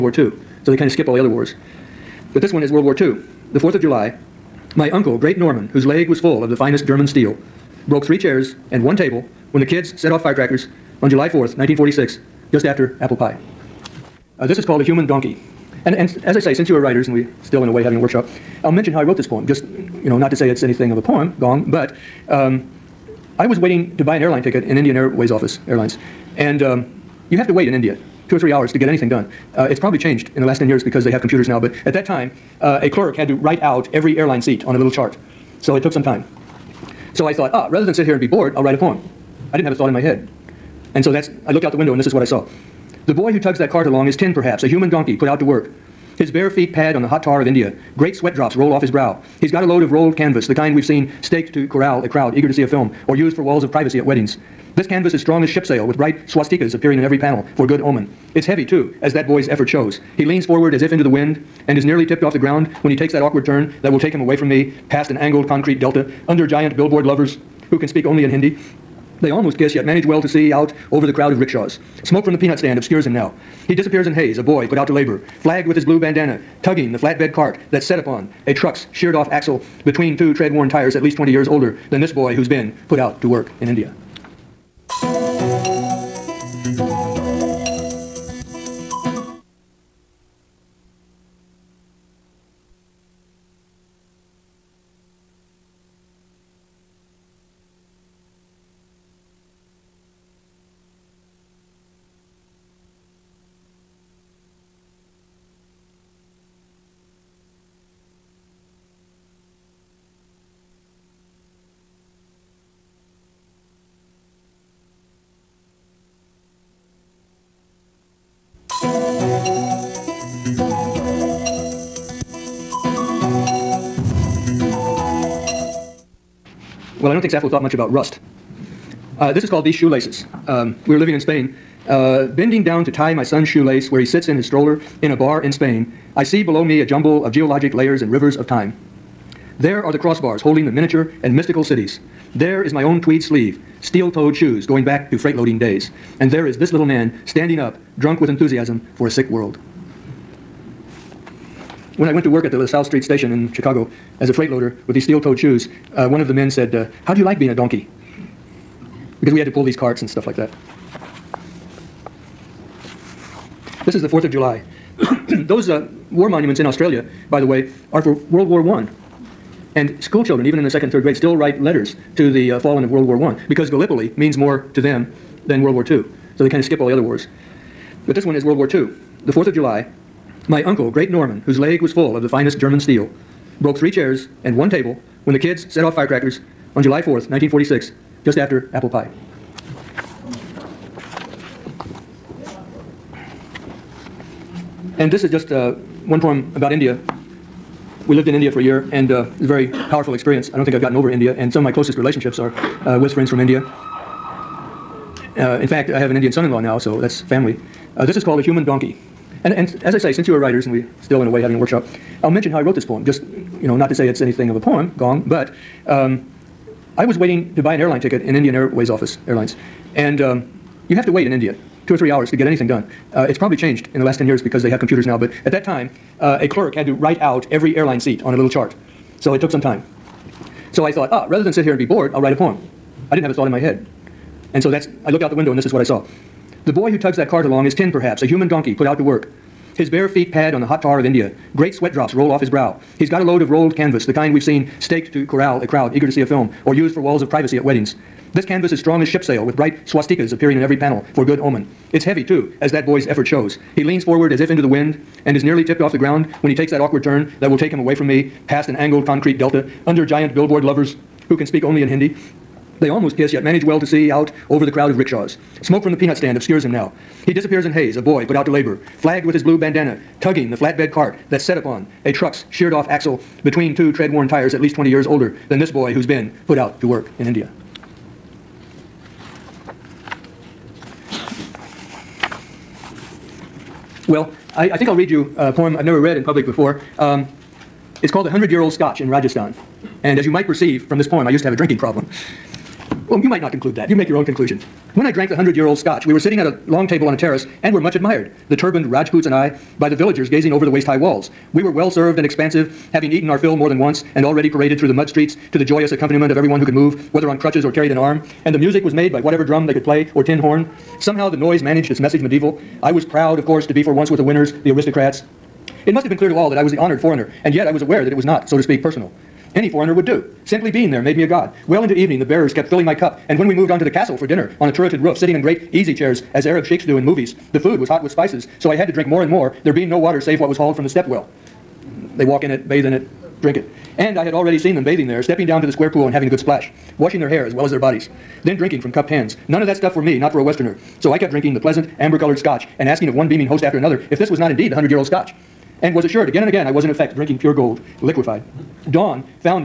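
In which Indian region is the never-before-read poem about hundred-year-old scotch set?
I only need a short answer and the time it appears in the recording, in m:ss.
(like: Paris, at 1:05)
Rajasthan, at 4:49.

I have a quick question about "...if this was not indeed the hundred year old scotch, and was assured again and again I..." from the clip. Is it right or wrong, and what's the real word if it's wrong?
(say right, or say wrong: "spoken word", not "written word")
right.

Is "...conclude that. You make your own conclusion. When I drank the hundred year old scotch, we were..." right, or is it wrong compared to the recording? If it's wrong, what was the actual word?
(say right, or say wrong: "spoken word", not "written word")
right.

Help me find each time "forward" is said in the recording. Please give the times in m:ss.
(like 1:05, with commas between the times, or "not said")
1:00, 4:14.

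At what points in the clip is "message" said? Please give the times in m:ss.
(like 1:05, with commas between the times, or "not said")
5:11.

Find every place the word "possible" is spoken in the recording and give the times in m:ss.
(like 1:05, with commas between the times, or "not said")
not said.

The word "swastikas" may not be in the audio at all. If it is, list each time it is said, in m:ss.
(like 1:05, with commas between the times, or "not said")
0:56, 4:09.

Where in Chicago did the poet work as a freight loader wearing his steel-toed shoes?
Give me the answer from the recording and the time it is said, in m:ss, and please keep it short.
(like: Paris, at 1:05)
LaSalle Street station, at 2:32.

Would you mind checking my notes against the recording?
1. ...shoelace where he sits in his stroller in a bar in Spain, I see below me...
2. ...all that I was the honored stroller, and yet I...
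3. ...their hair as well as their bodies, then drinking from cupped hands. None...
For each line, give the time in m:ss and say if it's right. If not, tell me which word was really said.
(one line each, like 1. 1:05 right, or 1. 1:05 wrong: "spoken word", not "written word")
1. 2:13 right
2. 5:16 wrong: "foreigner", not "stroller"
3. 5:37 right.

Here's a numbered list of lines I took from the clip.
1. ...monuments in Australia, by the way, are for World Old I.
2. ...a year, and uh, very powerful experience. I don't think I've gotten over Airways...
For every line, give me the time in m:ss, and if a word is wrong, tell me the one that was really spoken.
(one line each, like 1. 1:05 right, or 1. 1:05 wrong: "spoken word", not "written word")
1. 2:46 wrong: "War", not "Old"
2. 3:18 wrong: "India", not "Airways".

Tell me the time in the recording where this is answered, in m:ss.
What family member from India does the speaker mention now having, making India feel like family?
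3:26.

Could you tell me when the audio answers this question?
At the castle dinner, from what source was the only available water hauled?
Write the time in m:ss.
5:30.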